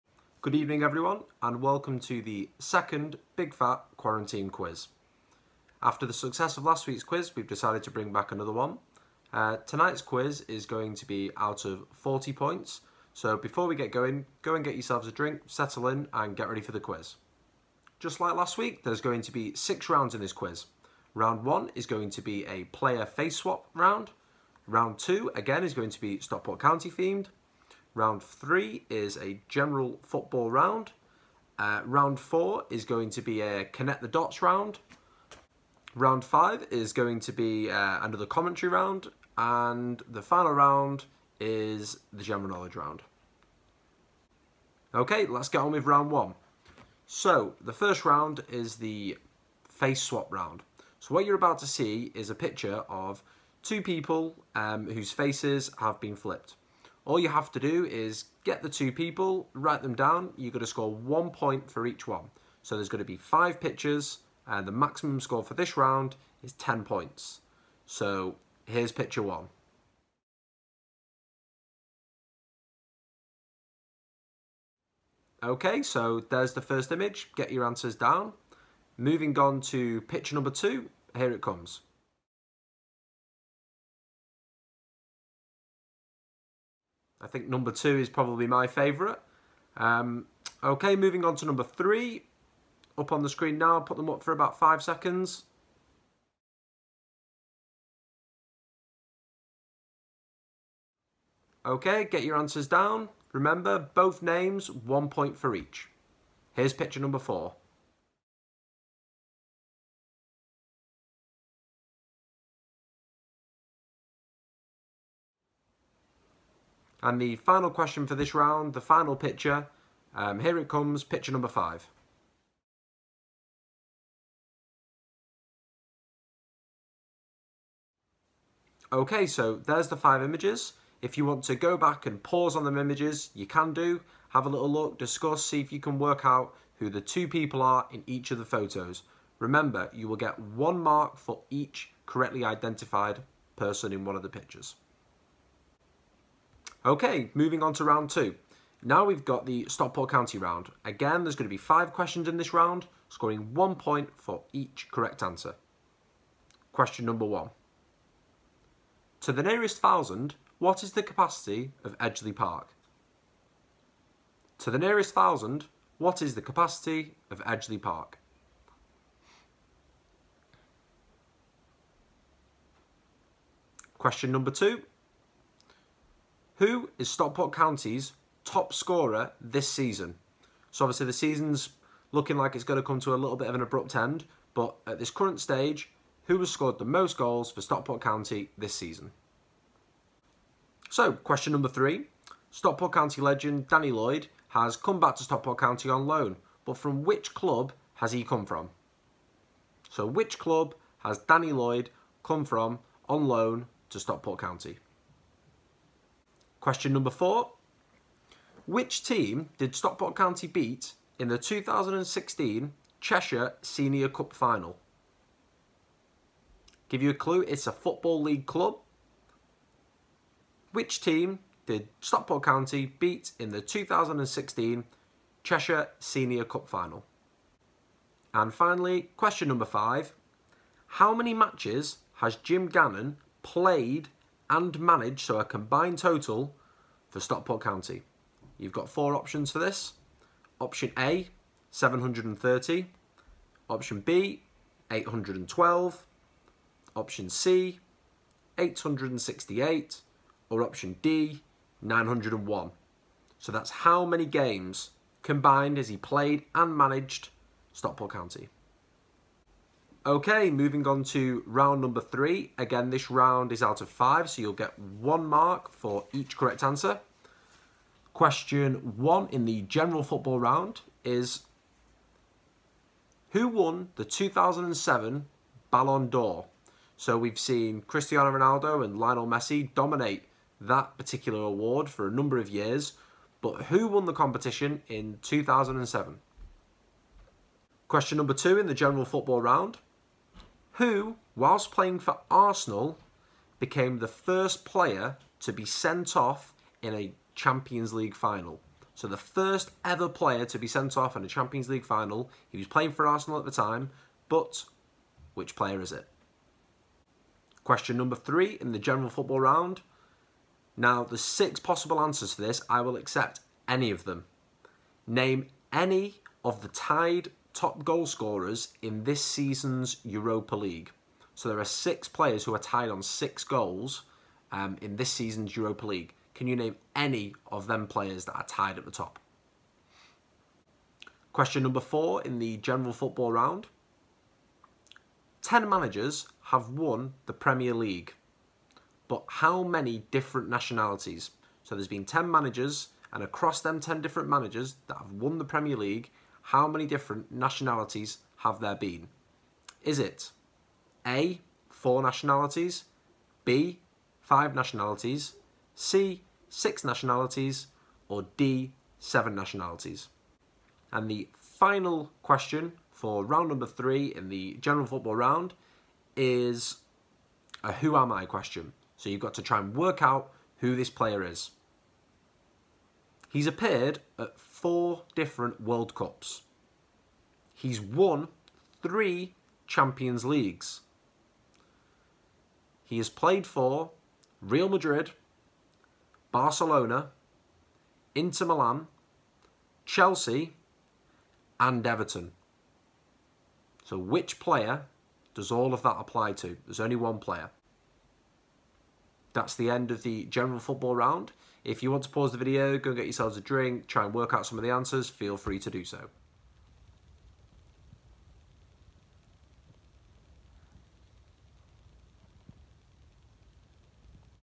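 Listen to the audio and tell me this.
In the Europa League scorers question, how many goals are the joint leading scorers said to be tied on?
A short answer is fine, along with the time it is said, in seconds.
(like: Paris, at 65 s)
6, at 323 s.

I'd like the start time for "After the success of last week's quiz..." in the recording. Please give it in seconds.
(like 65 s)
5 s.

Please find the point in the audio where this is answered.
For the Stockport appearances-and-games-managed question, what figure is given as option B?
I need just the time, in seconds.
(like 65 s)
244 s.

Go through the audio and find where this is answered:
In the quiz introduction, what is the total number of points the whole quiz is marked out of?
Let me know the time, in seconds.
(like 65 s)
11 s.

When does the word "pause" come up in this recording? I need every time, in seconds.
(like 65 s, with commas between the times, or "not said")
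132 s, 402 s.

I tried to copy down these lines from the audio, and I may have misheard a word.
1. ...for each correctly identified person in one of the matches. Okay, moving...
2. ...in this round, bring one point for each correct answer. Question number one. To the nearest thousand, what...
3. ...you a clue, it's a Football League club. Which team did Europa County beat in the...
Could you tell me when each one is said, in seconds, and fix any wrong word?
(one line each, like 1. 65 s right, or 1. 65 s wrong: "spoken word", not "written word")
1. 141 s wrong: "pictures", not "matches"
2. 152 s wrong: "scoring", not "bring"
3. 217 s wrong: "Stockport", not "Europa".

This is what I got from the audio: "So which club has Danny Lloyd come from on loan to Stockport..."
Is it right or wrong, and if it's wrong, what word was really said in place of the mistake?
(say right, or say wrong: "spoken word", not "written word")
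right.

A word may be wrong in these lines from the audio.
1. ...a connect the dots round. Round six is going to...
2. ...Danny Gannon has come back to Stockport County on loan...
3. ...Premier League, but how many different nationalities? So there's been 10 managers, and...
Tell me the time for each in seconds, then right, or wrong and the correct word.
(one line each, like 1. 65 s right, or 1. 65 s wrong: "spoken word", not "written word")
1. 33 s wrong: "five", not "six"
2. 193 s wrong: "Lloyd", not "Gannon"
3. 337 s right.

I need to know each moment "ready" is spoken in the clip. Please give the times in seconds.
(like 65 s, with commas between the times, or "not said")
16 s.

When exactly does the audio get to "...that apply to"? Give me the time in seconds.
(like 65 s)
395 s.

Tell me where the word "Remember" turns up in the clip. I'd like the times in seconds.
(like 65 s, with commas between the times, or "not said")
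103 s, 139 s.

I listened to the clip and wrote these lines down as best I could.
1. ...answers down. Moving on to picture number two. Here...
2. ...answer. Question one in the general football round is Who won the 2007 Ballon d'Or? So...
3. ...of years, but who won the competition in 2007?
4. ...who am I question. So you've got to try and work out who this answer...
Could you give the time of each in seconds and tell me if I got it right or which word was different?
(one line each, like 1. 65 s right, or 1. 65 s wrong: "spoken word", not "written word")
1. 77 s right
2. 266 s right
3. 282 s right
4. 367 s wrong: "player", not "answer".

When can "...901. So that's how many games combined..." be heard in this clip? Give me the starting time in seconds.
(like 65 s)
251 s.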